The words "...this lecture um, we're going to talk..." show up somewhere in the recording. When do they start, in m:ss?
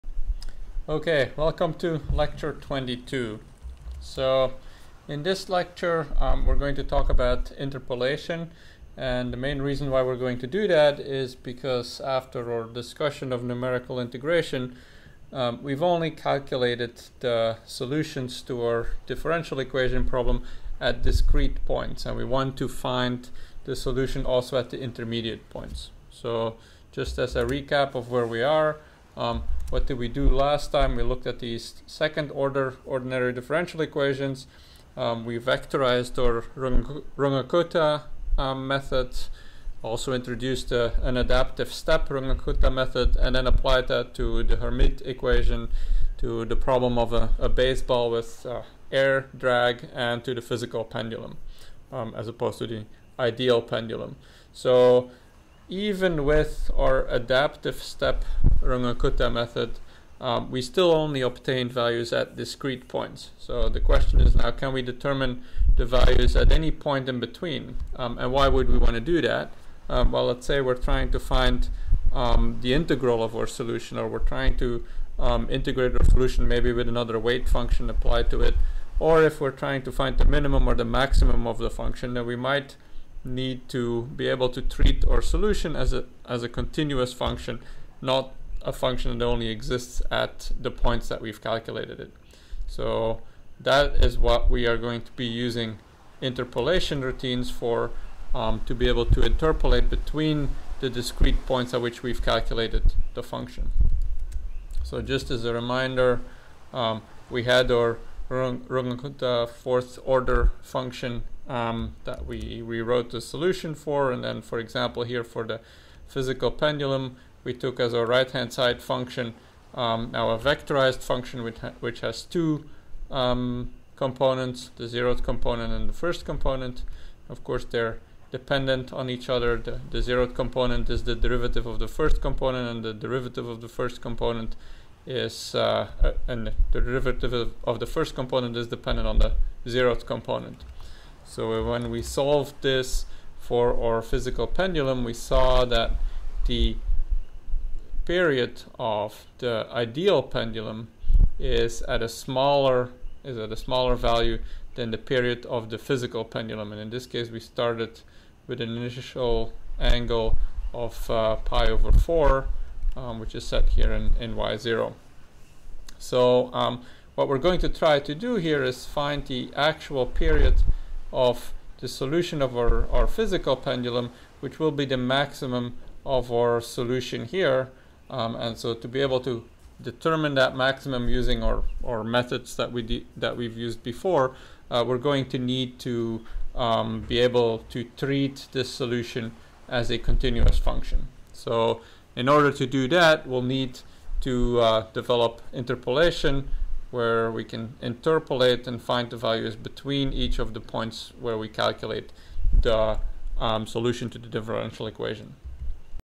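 0:05.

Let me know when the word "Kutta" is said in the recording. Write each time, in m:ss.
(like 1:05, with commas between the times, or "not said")
0:36, 0:42, 0:58, 1:48.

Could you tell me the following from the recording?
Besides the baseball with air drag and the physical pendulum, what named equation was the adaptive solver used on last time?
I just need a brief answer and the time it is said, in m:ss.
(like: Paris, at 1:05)
Hermite equation, at 0:44.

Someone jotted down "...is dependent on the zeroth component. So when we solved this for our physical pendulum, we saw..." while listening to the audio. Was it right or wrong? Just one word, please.
right.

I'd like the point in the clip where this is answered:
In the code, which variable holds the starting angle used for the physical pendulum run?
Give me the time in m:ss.
2:44.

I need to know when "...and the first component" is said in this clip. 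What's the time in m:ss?
2:05.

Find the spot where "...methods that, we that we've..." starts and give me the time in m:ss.
3:02.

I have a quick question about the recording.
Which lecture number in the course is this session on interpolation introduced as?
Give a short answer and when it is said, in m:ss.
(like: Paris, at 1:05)
22, at 0:02.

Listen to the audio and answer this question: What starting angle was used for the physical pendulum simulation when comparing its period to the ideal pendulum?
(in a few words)
pi over 4.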